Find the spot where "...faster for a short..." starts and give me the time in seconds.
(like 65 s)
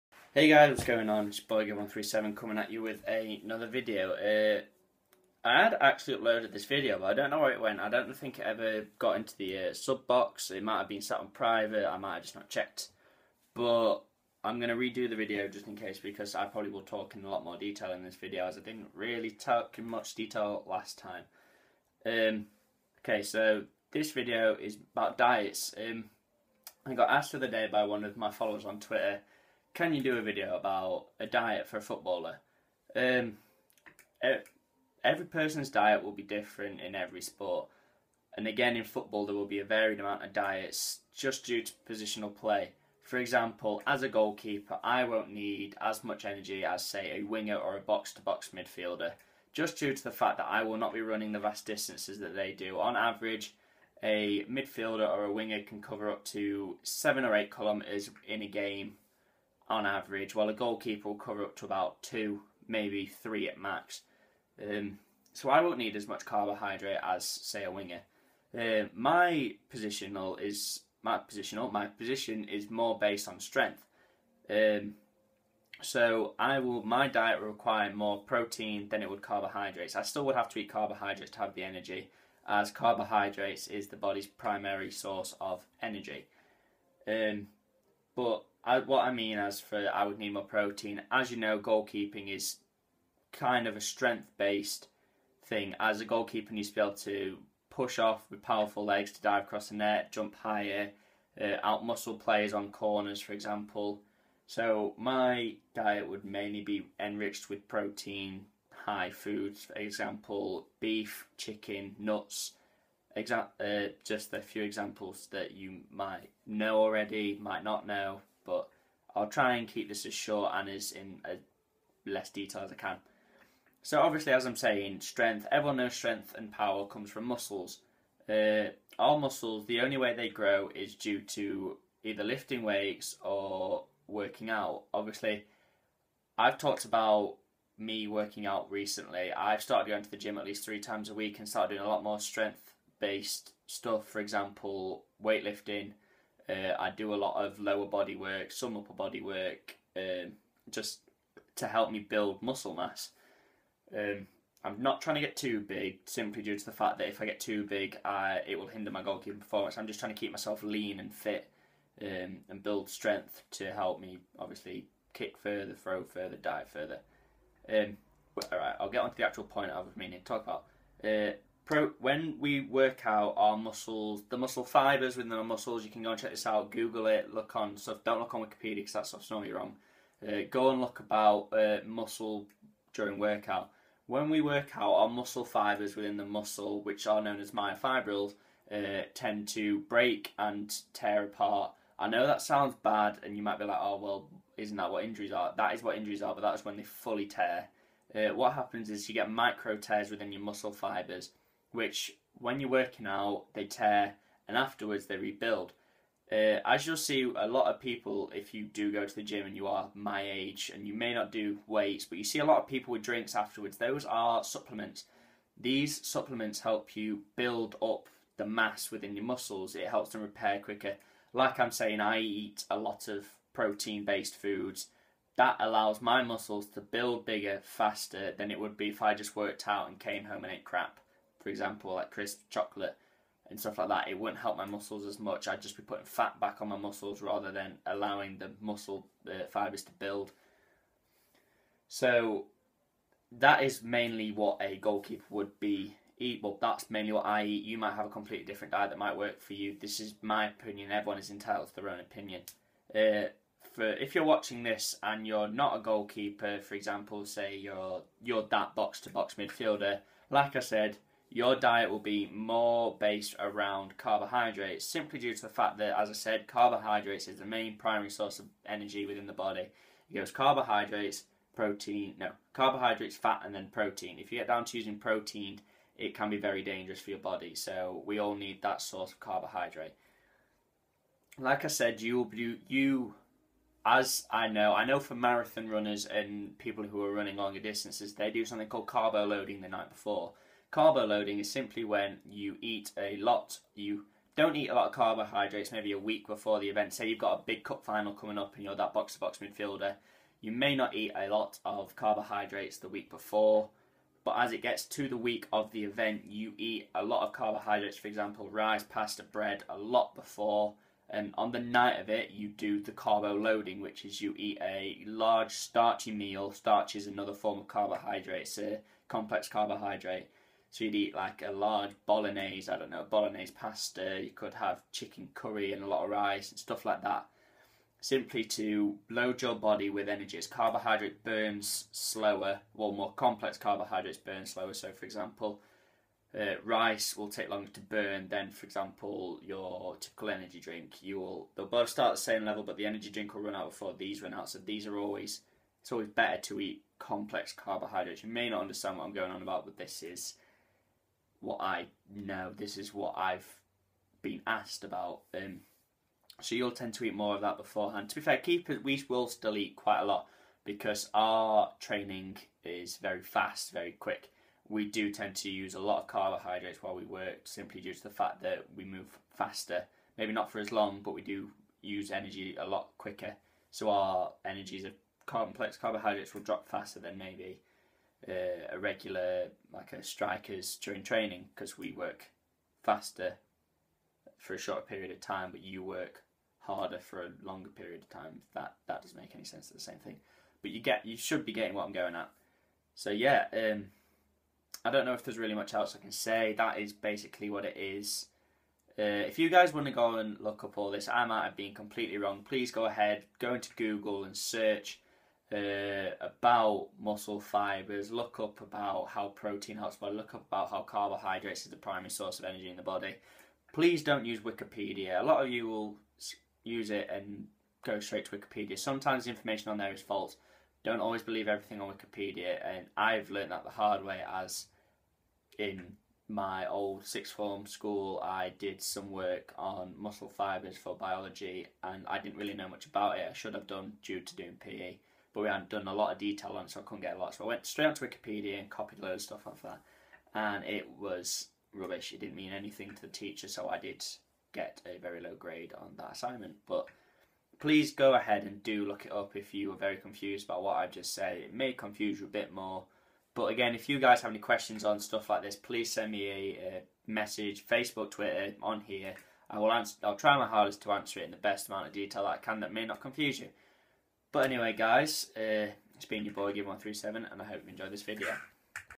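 382 s.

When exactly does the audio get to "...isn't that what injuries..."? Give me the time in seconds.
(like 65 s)
194 s.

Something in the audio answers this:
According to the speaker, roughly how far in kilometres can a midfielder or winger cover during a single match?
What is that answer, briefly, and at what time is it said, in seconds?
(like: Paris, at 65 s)
7 or 8 kilometres, at 56 s.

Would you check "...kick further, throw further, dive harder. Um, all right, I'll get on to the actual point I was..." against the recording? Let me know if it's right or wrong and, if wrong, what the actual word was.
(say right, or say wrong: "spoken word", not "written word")
wrong: "further", not "harder".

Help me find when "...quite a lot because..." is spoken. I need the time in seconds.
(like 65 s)
359 s.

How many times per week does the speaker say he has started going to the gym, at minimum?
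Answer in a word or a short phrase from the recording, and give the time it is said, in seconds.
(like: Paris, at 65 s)
3, at 140 s.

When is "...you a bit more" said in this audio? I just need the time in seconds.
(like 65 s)
452 s.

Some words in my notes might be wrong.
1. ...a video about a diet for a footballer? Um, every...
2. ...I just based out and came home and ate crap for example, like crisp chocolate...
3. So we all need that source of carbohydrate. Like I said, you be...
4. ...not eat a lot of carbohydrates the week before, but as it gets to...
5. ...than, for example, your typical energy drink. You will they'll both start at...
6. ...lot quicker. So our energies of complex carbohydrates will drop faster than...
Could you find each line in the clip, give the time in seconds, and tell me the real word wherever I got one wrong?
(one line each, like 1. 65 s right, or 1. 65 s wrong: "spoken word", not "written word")
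1. 30 s right
2. 229 s wrong: "worked", not "based"
3. 277 s right
4. 300 s right
5. 338 s right
6. 372 s right.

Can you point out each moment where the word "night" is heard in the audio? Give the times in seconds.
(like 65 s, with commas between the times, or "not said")
289 s, 311 s.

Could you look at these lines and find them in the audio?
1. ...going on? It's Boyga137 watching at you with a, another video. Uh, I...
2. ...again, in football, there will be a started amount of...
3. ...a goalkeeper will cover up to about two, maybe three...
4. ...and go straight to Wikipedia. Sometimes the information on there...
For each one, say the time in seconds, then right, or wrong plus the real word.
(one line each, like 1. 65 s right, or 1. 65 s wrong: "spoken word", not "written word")
1. 0 s wrong: "coming", not "watching"
2. 38 s wrong: "varied", not "started"
3. 60 s right
4. 417 s right.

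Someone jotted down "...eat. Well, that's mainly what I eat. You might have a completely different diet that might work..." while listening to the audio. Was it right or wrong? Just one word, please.
right.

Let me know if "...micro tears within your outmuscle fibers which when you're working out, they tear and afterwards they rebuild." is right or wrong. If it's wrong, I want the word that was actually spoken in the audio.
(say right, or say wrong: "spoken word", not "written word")
wrong: "muscle", not "outmuscle".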